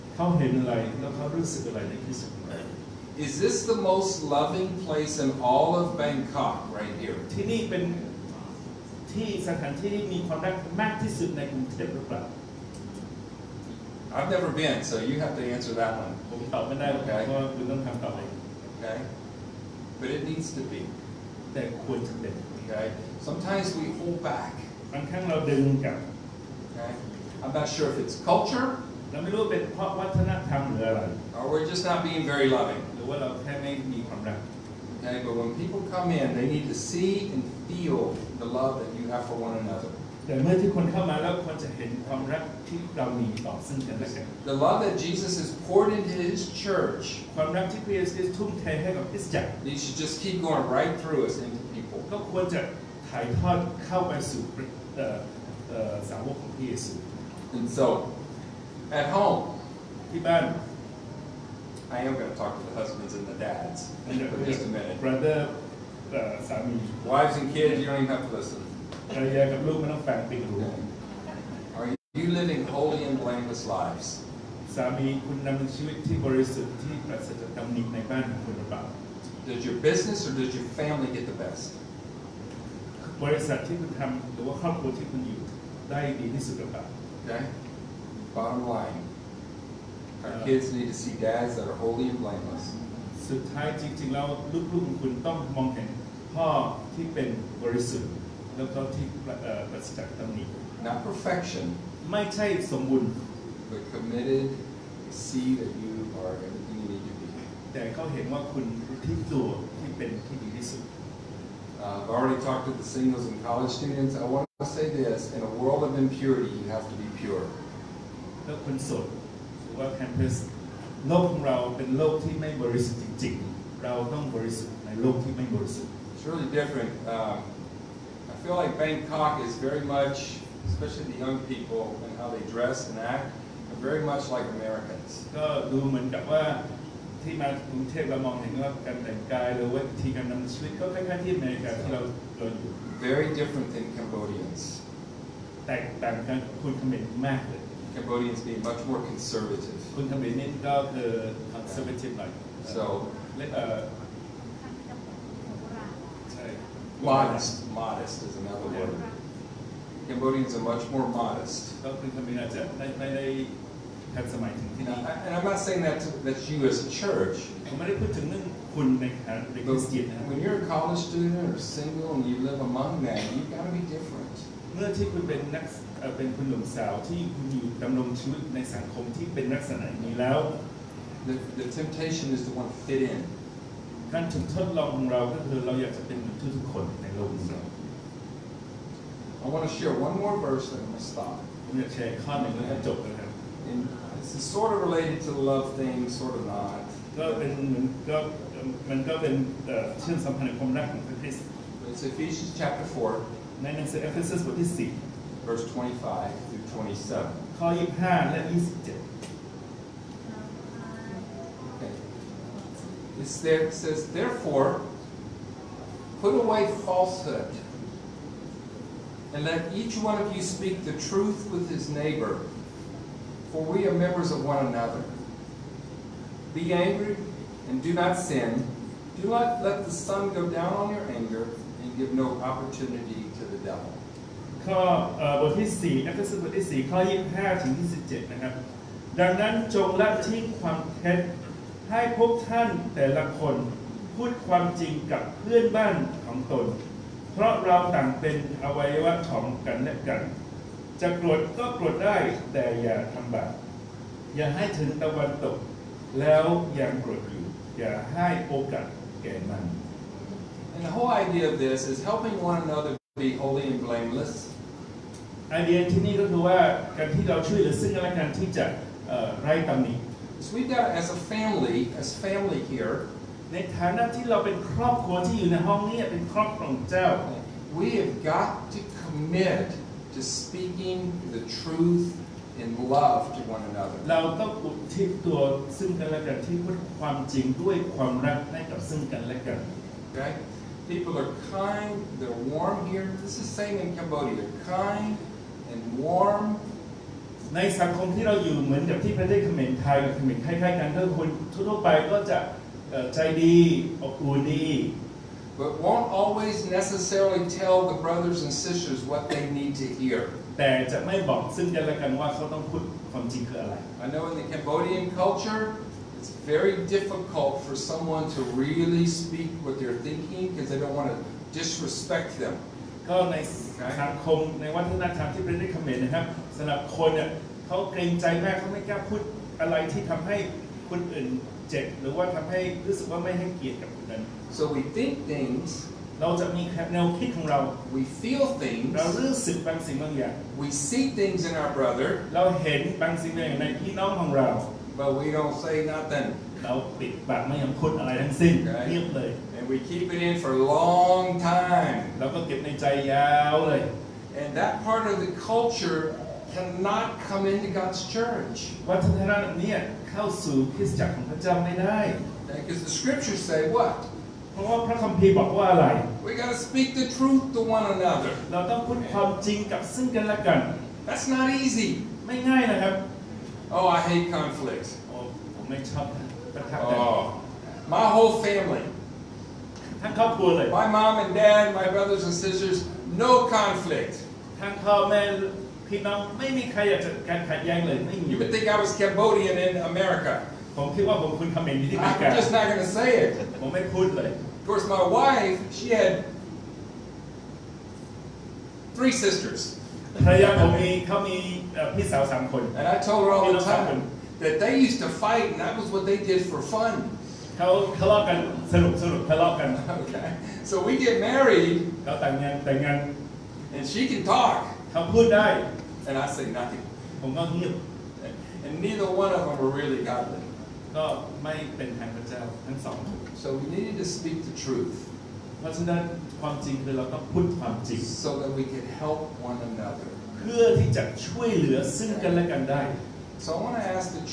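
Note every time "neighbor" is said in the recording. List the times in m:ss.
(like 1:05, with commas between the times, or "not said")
3:41.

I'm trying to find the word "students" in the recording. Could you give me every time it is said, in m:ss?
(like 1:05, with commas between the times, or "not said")
1:53, 2:51.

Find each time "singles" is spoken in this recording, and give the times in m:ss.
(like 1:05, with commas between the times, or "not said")
1:52, 2:51.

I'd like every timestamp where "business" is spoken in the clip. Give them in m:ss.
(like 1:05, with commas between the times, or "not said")
1:19.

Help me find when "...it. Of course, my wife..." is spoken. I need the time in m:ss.
6:33.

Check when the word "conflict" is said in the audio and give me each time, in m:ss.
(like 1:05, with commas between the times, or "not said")
6:14, 6:23.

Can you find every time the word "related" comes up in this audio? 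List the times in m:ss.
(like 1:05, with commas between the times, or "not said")
3:14.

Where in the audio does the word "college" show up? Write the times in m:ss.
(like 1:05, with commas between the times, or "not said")
1:53, 2:50.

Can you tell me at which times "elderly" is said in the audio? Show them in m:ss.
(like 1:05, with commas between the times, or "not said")
not said.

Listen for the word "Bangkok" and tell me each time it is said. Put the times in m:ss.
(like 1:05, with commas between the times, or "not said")
0:06, 2:08.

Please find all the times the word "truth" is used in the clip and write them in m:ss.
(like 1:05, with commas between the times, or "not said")
3:40, 6:07, 7:04.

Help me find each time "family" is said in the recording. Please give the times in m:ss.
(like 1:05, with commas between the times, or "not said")
1:20, 6:18.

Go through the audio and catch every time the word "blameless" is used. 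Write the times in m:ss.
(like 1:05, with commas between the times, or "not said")
1:13, 1:32, 4:23.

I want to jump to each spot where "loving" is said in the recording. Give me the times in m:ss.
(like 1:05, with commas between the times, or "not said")
0:04, 0:32.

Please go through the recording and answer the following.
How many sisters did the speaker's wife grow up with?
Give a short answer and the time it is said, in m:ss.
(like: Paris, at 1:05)
3, at 6:38.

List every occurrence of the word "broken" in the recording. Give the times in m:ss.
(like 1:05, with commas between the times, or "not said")
not said.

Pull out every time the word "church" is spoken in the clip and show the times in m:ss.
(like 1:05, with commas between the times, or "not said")
0:46, 2:47, 5:58.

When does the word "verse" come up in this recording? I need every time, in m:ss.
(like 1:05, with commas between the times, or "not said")
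3:10, 3:25.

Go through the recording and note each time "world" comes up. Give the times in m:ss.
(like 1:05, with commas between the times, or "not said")
1:55.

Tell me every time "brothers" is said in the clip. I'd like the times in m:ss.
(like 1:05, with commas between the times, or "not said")
1:04, 5:08, 5:41, 6:21.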